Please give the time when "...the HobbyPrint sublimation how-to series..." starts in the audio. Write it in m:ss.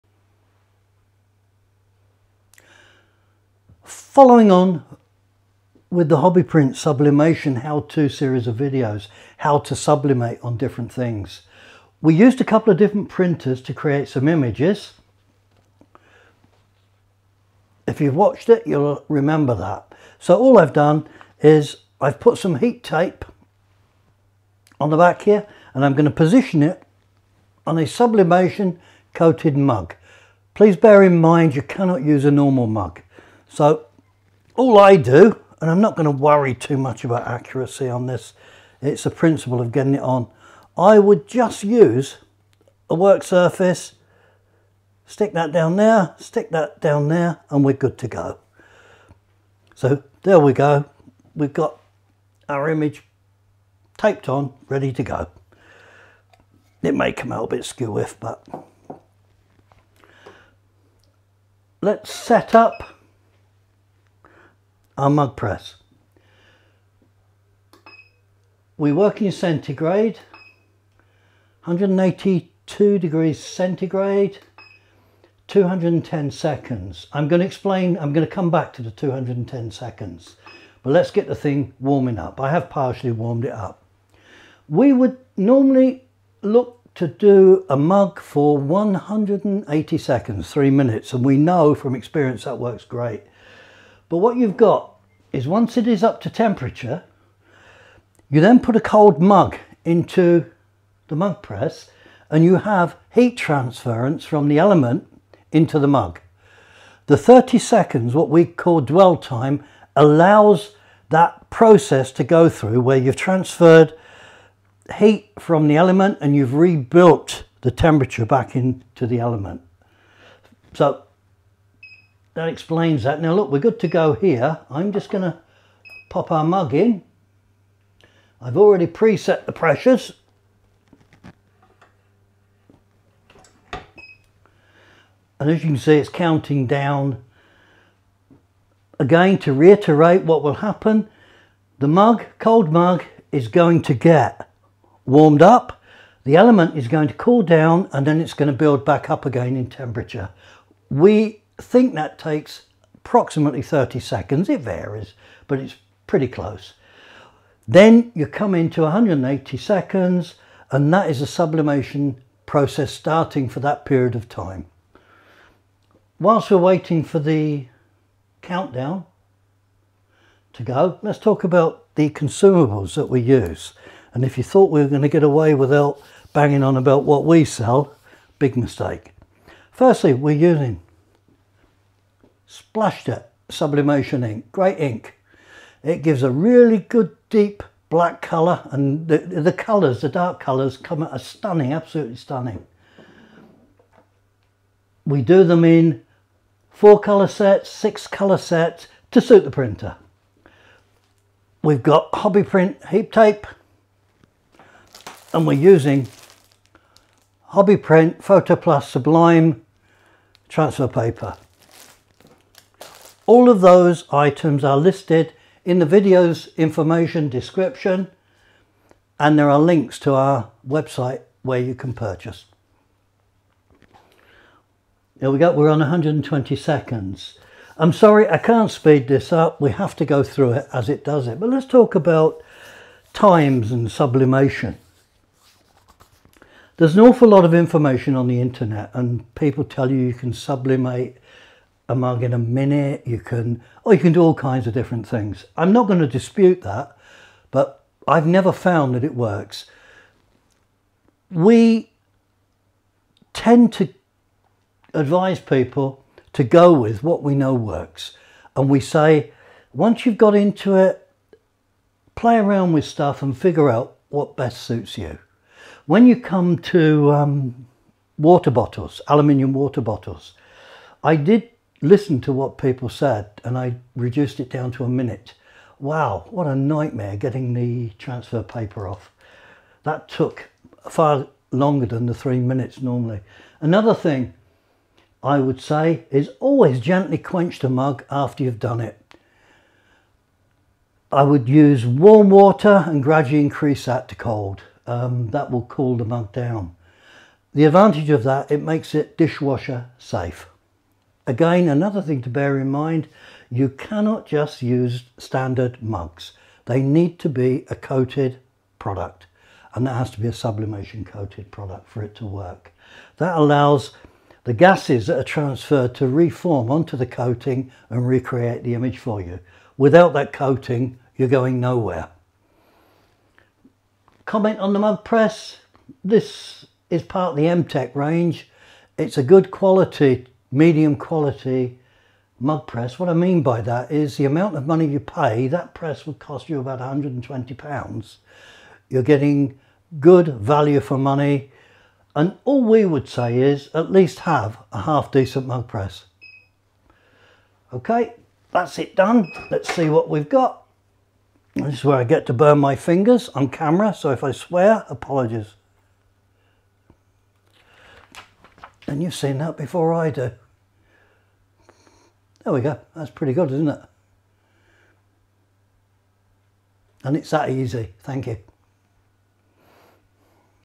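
0:06.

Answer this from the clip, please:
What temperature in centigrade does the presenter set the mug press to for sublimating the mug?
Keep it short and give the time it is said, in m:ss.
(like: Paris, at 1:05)
182 degrees, at 1:11.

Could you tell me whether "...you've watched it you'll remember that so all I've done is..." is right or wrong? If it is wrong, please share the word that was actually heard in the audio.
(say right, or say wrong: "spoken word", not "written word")
right.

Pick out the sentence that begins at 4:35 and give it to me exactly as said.
Wow, what a nightmare getting the transfer paper off.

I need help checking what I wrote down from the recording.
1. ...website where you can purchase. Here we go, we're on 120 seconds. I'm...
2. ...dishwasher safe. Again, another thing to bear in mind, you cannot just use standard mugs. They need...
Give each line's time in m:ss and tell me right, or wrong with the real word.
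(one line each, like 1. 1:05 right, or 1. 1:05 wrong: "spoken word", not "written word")
1. 3:40 right
2. 4:59 right.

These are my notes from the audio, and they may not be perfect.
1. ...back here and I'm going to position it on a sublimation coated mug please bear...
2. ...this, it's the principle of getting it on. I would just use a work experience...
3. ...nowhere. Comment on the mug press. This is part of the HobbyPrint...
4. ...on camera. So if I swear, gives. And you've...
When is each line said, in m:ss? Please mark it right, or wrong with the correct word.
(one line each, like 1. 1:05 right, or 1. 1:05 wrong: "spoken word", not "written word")
1. 0:24 right
2. 0:38 wrong: "surface", not "experience"
3. 5:21 wrong: "MTech", not "HobbyPrint"
4. 5:53 wrong: "apologies", not "gives".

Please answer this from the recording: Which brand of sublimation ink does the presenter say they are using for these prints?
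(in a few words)
SplashJet.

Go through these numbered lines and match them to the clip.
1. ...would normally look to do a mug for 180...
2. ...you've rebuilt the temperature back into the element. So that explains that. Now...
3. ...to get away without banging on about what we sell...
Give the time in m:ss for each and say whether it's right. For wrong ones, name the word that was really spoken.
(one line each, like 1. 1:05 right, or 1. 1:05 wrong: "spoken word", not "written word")
1. 1:24 right
2. 1:56 right
3. 2:55 right.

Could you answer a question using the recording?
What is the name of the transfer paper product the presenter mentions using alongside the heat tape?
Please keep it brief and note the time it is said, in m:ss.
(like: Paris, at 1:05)
hobby print plus sublime, at 3:27.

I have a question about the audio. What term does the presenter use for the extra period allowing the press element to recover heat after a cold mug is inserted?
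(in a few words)
dwell time.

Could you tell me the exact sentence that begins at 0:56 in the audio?
It may come out a bit skew if but let's set up our mug press.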